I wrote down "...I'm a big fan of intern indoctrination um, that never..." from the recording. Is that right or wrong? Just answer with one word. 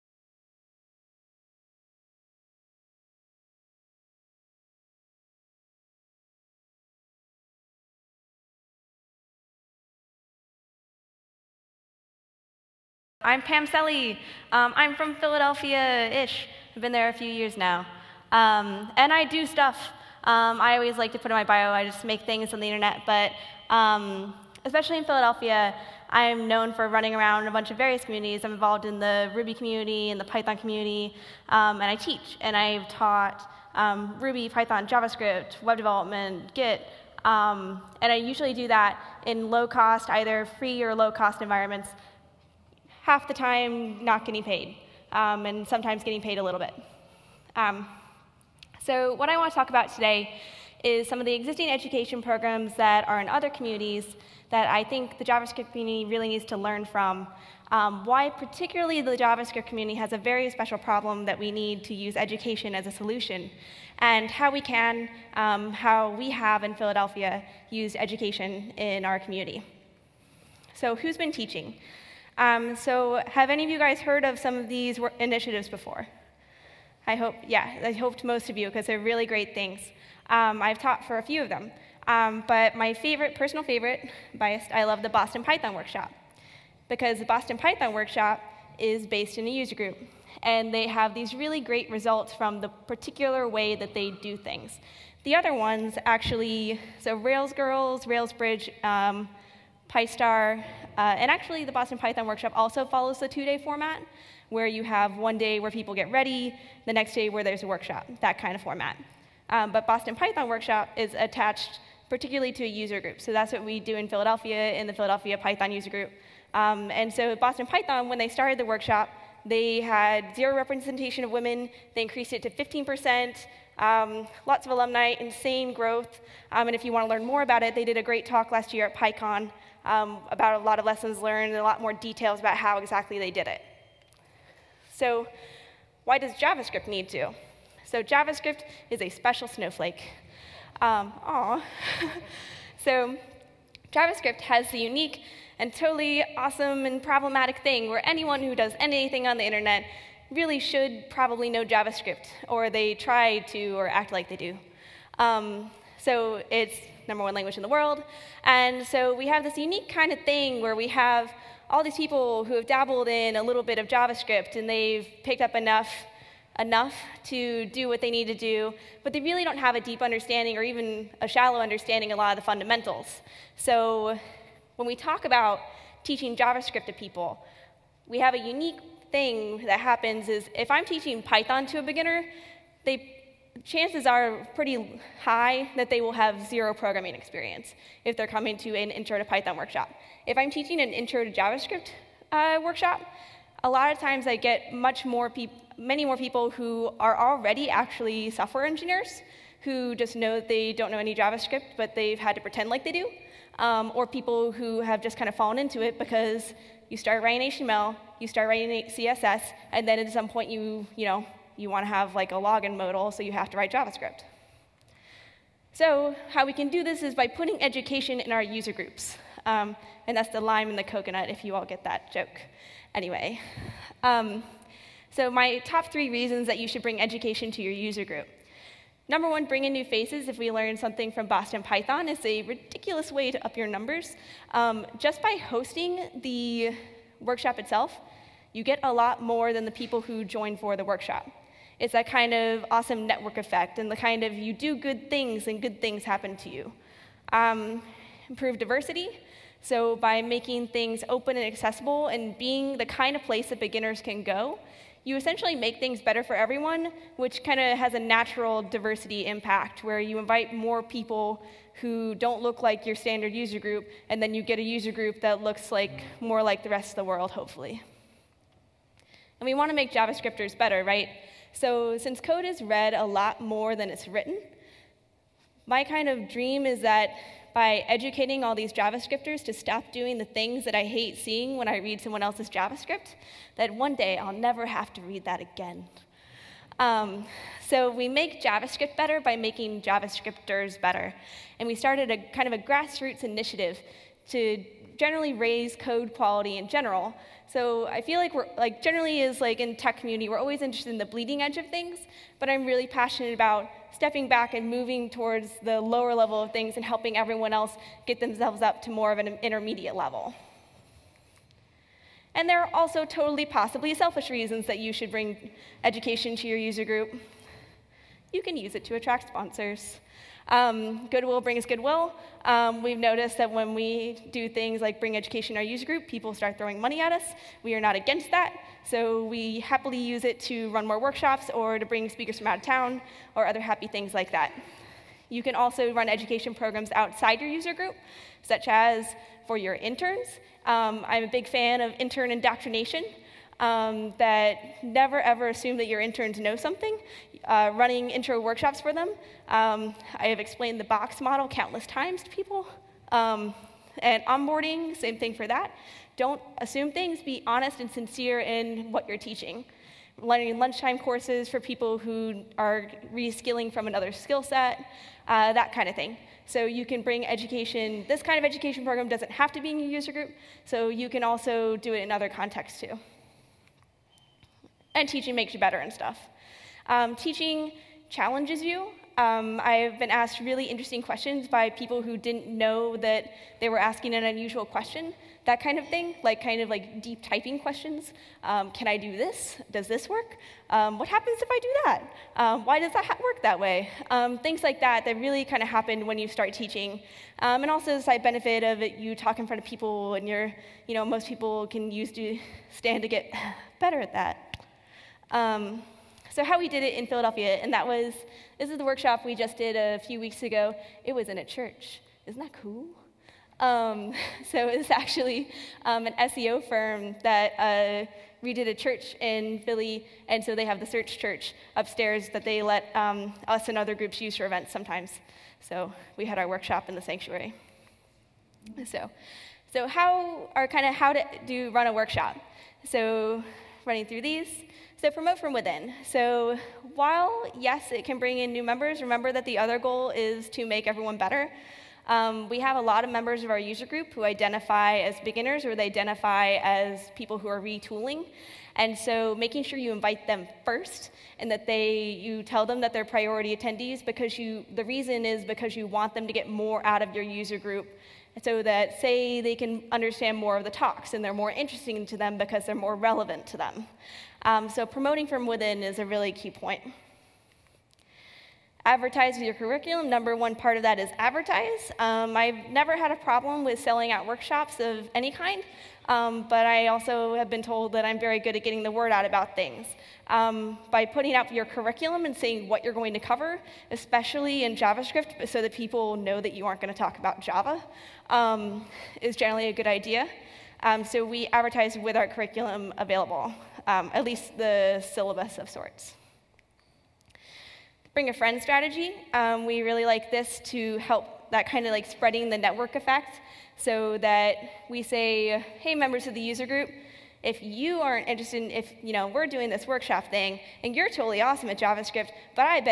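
right.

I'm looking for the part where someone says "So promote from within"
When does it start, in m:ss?
7:15.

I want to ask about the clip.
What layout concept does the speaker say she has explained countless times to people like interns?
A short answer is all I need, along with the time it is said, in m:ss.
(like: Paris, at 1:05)
the box model, at 5:50.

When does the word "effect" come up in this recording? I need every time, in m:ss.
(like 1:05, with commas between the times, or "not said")
4:03, 8:22.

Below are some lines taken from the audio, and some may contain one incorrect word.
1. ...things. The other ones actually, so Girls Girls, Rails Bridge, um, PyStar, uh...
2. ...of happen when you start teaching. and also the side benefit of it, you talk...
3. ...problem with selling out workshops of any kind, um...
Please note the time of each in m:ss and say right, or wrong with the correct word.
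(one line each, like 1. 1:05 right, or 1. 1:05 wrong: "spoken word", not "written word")
1. 1:34 wrong: "Rails", not "Girls"
2. 6:35 right
3. 7:53 right.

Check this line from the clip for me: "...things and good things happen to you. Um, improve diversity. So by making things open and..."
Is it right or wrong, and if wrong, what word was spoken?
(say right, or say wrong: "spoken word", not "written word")
right.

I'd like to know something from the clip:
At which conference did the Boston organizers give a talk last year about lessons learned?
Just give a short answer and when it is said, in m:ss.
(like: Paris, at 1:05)
PyCon, at 2:08.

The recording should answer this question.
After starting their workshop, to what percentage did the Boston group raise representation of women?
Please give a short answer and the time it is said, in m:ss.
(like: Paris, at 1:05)
15%, at 2:02.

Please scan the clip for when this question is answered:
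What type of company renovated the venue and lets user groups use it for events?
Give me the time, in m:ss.
6:56.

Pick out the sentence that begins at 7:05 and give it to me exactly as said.
So we had our workshop in the sanctuary.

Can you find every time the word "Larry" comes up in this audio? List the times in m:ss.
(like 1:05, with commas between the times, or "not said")
not said.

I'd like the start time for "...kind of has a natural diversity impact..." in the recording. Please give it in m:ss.
4:17.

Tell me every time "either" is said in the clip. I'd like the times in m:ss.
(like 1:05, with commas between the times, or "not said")
0:40.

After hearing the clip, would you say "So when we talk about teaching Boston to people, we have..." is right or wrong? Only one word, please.
wrong.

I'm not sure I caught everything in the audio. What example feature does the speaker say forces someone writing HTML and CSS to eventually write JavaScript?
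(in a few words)
a login modal.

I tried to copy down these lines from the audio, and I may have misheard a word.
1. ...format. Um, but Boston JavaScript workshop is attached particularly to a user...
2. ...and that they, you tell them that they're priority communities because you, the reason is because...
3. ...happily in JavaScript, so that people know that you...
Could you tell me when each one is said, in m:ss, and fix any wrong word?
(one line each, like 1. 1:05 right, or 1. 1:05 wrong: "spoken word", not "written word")
1. 1:48 wrong: "Python", not "JavaScript"
2. 7:31 wrong: "attendees", not "communities"
3. 8:03 wrong: "especially", not "happily".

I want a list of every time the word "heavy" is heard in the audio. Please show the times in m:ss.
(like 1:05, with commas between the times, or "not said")
not said.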